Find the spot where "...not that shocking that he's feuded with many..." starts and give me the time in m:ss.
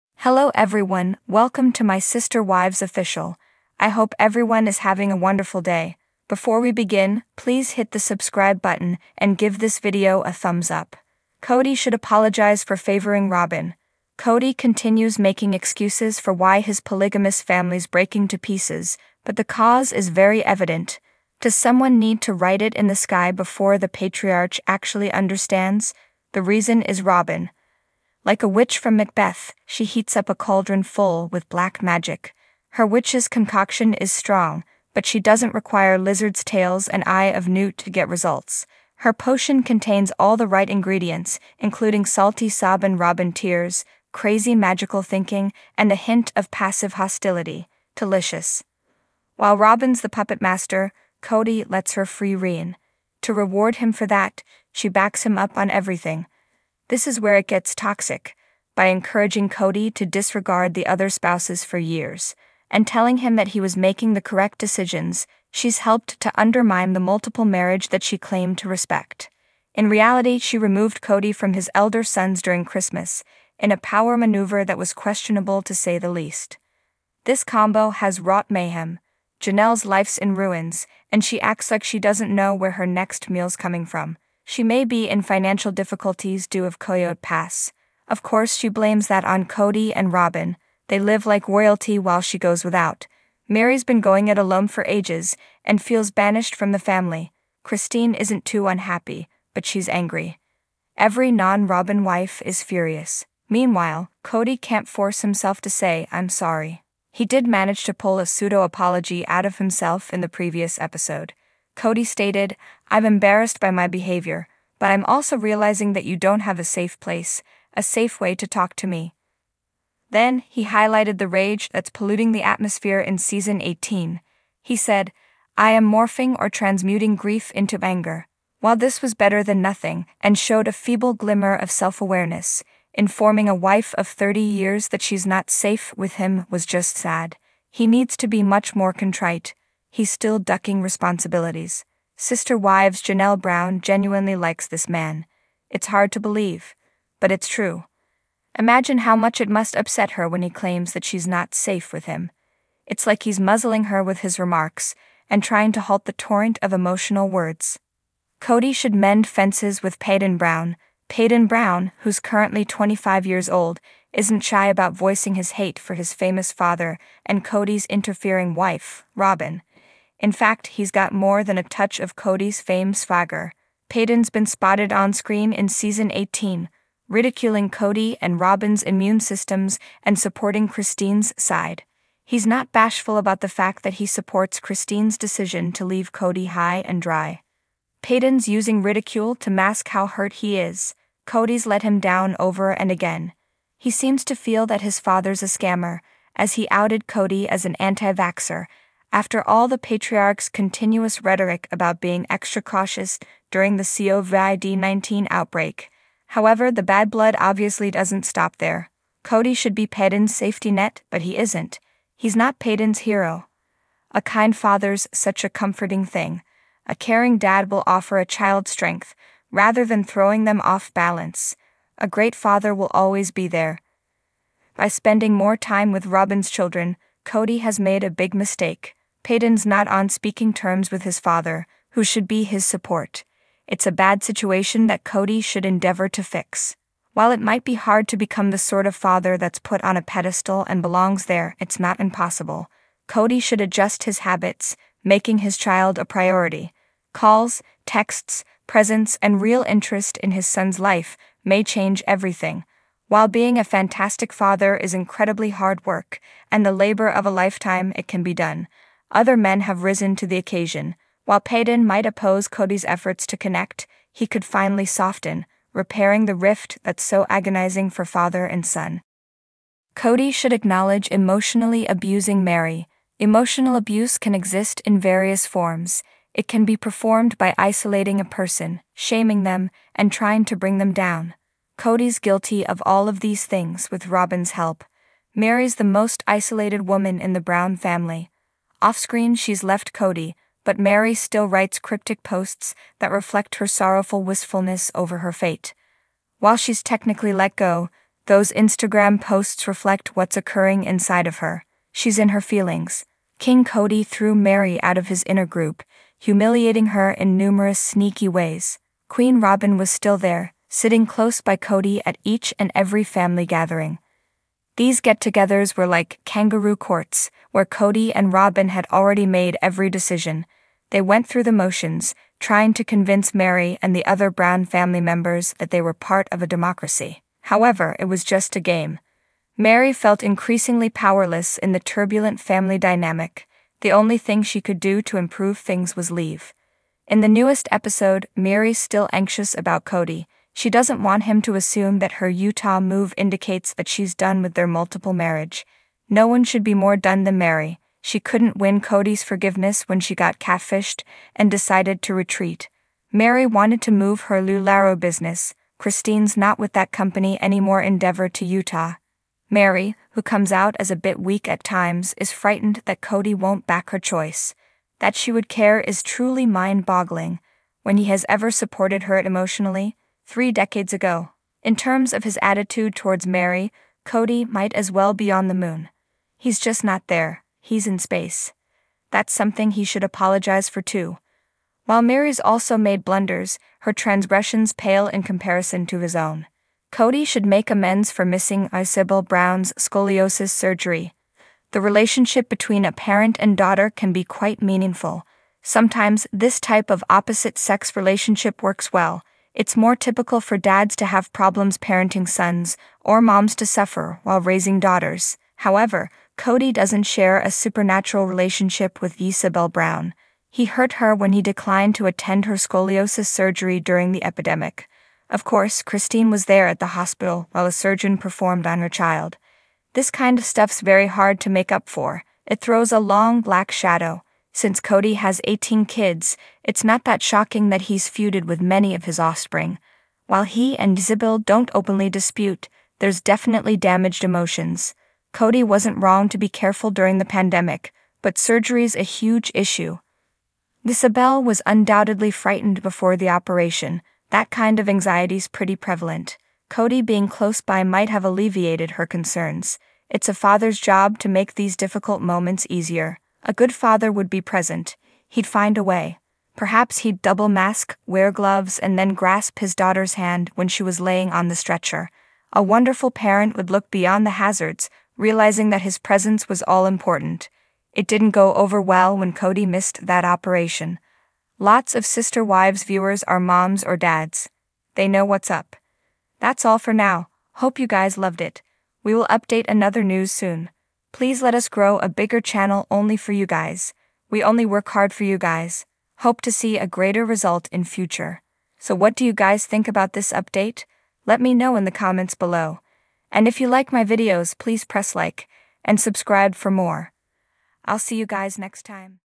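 7:06.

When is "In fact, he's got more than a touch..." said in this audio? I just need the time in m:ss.
2:50.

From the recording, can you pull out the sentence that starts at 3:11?
Kody's let him down over and again.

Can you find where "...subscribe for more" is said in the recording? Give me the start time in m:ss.
8:15.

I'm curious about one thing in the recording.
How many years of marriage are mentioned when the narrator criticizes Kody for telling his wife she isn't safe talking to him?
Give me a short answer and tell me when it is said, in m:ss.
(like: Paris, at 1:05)
30, at 2:14.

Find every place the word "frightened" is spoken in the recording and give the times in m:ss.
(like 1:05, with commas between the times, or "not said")
6:02, 7:22.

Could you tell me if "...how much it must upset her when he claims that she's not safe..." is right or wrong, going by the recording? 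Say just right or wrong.
right.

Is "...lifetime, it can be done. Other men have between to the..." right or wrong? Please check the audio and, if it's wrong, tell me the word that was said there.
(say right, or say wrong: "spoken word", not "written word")
wrong: "risen", not "between".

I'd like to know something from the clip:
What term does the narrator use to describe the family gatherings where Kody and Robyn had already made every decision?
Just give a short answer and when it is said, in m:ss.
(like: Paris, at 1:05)
kangaroo courts, at 5:16.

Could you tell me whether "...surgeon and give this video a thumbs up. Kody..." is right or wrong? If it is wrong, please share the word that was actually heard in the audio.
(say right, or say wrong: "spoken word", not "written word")
wrong: "button", not "surgeon".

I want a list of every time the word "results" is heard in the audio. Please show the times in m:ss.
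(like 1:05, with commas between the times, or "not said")
0:38, 8:07.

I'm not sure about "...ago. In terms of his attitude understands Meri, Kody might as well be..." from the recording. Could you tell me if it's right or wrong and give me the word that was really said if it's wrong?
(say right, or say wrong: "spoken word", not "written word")
wrong: "towards", not "understands".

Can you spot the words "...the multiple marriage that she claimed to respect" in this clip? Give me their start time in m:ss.
1:06.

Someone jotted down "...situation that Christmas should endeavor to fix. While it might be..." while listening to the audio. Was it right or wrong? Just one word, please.
wrong.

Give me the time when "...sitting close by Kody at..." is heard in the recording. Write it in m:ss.
5:10.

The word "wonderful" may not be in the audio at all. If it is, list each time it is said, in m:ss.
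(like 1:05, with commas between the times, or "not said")
0:05, 7:42.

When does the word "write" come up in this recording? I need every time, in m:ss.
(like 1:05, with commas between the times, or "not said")
0:22, 4:51.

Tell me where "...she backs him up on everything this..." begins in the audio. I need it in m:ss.
0:54.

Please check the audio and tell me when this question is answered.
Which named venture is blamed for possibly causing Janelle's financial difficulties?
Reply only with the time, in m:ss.
1:26.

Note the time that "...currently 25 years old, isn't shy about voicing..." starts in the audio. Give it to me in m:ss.
2:42.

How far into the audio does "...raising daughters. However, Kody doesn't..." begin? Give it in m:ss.
6:44.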